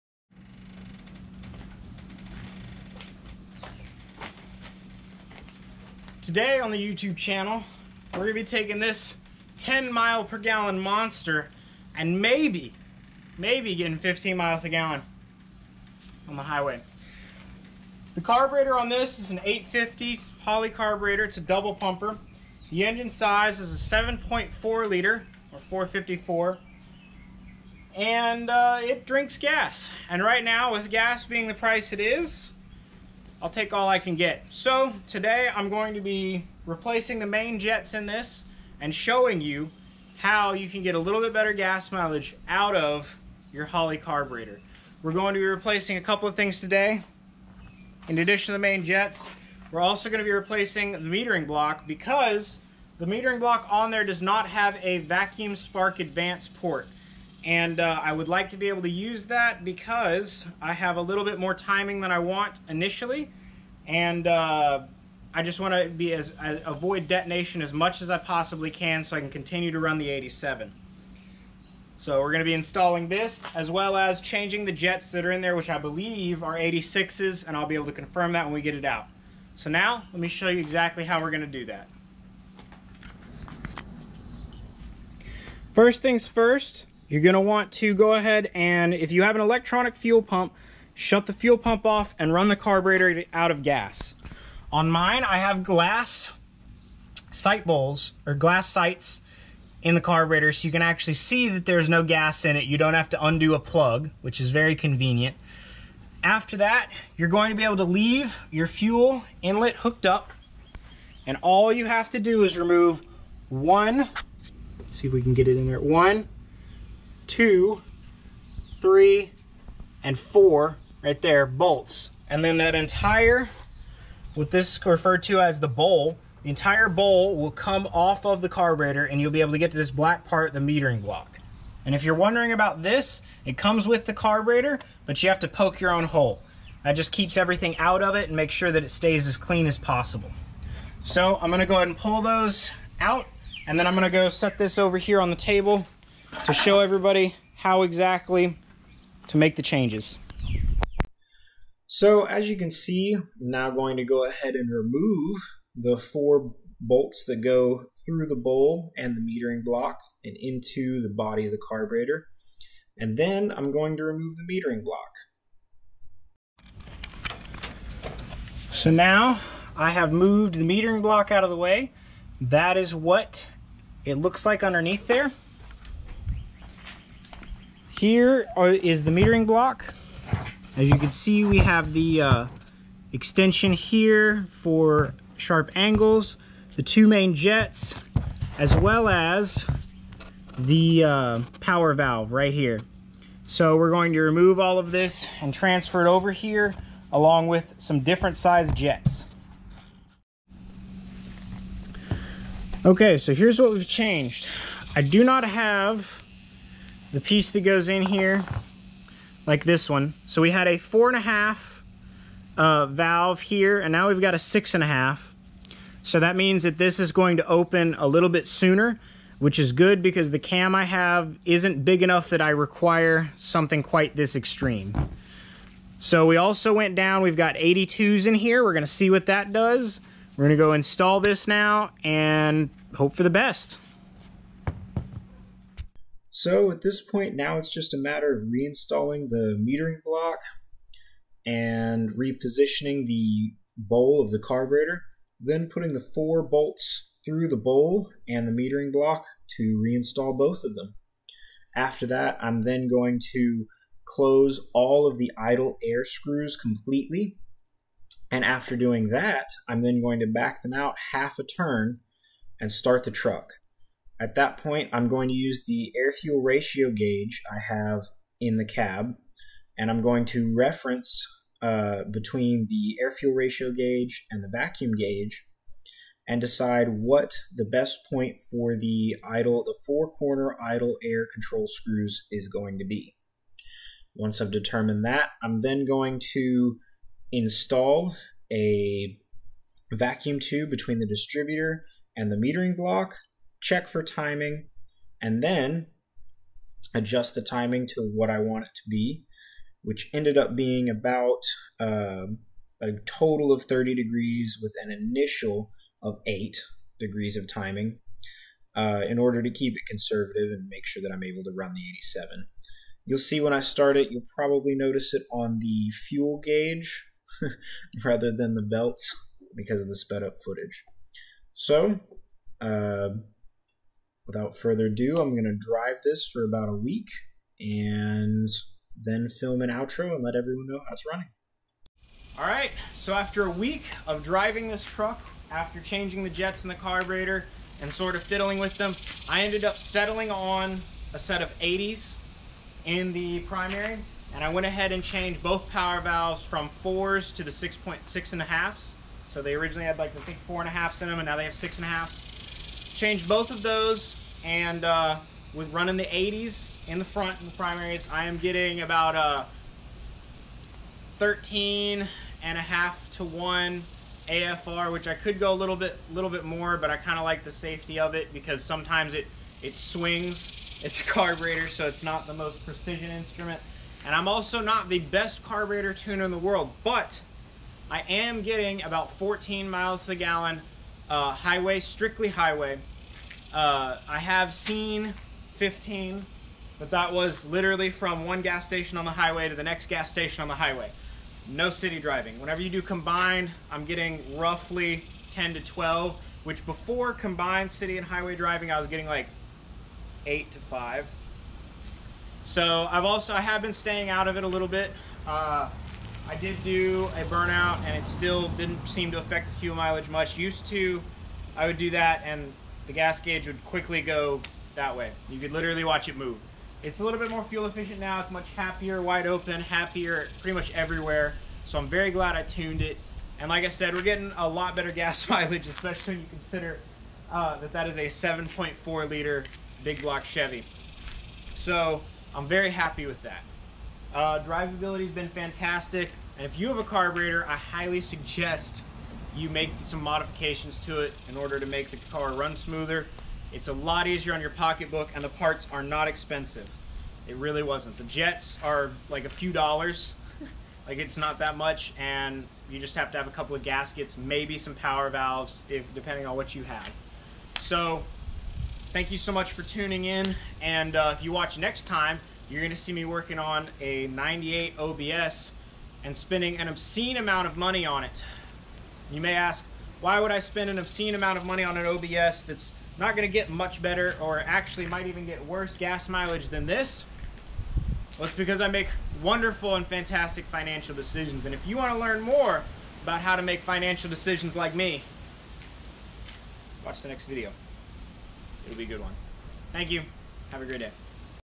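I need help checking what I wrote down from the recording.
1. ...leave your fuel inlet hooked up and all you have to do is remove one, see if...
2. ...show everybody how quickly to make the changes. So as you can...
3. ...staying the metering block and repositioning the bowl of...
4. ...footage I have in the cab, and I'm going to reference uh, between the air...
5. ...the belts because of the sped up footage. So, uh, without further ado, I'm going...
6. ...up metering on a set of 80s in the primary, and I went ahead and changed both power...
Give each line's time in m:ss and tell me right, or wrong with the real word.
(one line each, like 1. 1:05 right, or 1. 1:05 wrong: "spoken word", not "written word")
1. 1:47 right
2. 2:26 wrong: "exactly", not "quickly"
3. 3:58 wrong: "reinstalling", not "staying"
4. 4:26 wrong: "gauge", not "footage"
5. 5:18 right
6. 5:39 wrong: "settling", not "metering".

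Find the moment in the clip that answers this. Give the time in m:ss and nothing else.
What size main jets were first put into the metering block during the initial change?
3:47.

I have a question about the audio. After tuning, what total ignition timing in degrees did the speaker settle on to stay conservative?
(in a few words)
30 degrees.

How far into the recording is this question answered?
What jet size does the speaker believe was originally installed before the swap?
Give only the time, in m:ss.
1:16.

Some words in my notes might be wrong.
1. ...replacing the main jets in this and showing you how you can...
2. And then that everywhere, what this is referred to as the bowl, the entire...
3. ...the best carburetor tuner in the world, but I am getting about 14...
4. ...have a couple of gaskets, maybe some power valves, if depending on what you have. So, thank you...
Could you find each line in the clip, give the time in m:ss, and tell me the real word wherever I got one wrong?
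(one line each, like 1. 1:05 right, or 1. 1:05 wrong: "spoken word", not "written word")
1. 0:36 right
2. 2:02 wrong: "entire", not "everywhere"
3. 6:14 right
4. 7:33 right.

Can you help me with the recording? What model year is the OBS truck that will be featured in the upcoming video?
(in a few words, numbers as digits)
98.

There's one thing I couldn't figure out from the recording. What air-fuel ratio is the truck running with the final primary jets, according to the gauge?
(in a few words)
13.5 to 1.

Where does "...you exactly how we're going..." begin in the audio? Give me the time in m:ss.
1:20.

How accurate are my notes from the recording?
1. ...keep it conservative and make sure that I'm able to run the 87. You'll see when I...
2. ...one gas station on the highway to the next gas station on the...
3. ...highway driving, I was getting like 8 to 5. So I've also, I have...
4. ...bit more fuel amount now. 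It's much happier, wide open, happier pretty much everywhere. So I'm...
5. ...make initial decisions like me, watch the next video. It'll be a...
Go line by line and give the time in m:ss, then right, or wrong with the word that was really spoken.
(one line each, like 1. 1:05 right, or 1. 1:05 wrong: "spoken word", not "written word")
1. 5:09 right
2. 6:28 right
3. 6:38 right
4. 6:57 wrong: "efficient", not "amount"
5. 8:03 wrong: "financial", not "initial".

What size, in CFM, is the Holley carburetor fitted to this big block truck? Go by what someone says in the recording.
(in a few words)
850.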